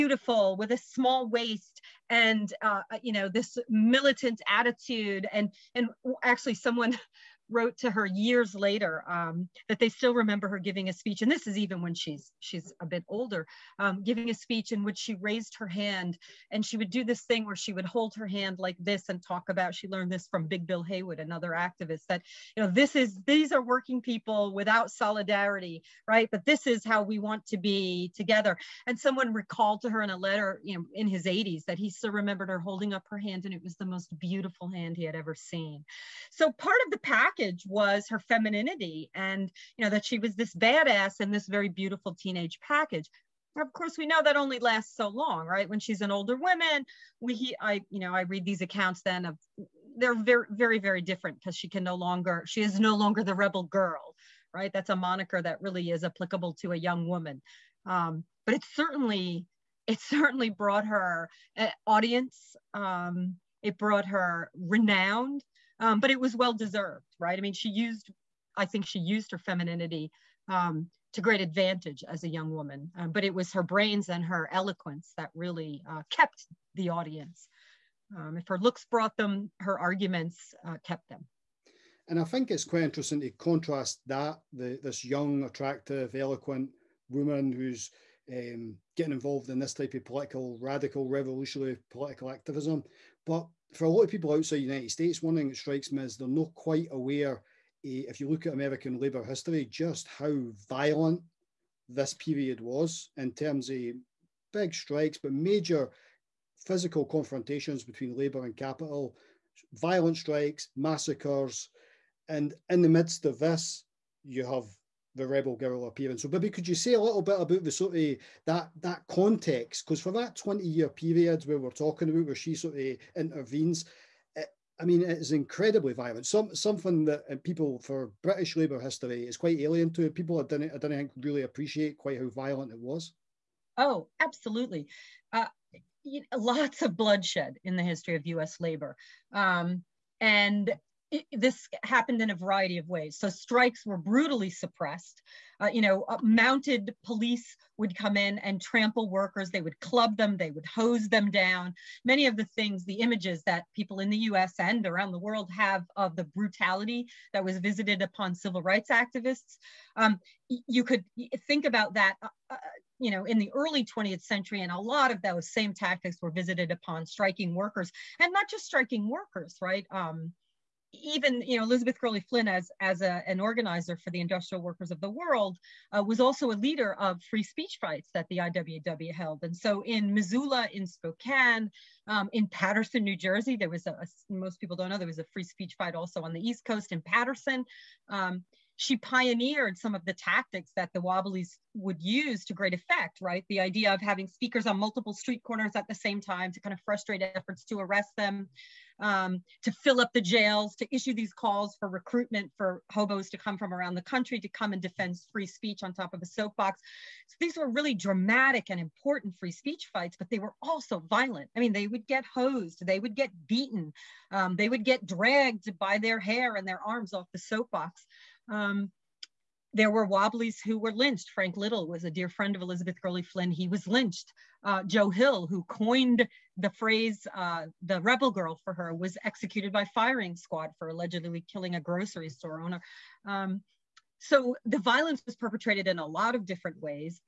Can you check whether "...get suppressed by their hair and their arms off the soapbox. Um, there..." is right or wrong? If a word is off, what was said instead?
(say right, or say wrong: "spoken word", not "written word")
wrong: "dragged", not "suppressed".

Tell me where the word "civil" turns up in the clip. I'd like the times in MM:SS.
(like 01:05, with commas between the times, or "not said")
02:38.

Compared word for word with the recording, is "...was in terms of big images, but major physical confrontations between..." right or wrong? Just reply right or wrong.
wrong.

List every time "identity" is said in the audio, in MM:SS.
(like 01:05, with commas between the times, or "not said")
not said.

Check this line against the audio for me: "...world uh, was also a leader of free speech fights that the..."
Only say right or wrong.
right.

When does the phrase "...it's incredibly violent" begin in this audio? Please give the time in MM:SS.
02:05.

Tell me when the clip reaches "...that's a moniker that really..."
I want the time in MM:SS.
00:54.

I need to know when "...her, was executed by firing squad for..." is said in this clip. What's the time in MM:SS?
03:48.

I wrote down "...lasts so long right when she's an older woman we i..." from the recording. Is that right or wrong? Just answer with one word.
right.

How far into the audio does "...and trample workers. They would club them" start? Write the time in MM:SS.
02:28.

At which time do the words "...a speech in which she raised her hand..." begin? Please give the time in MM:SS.
00:14.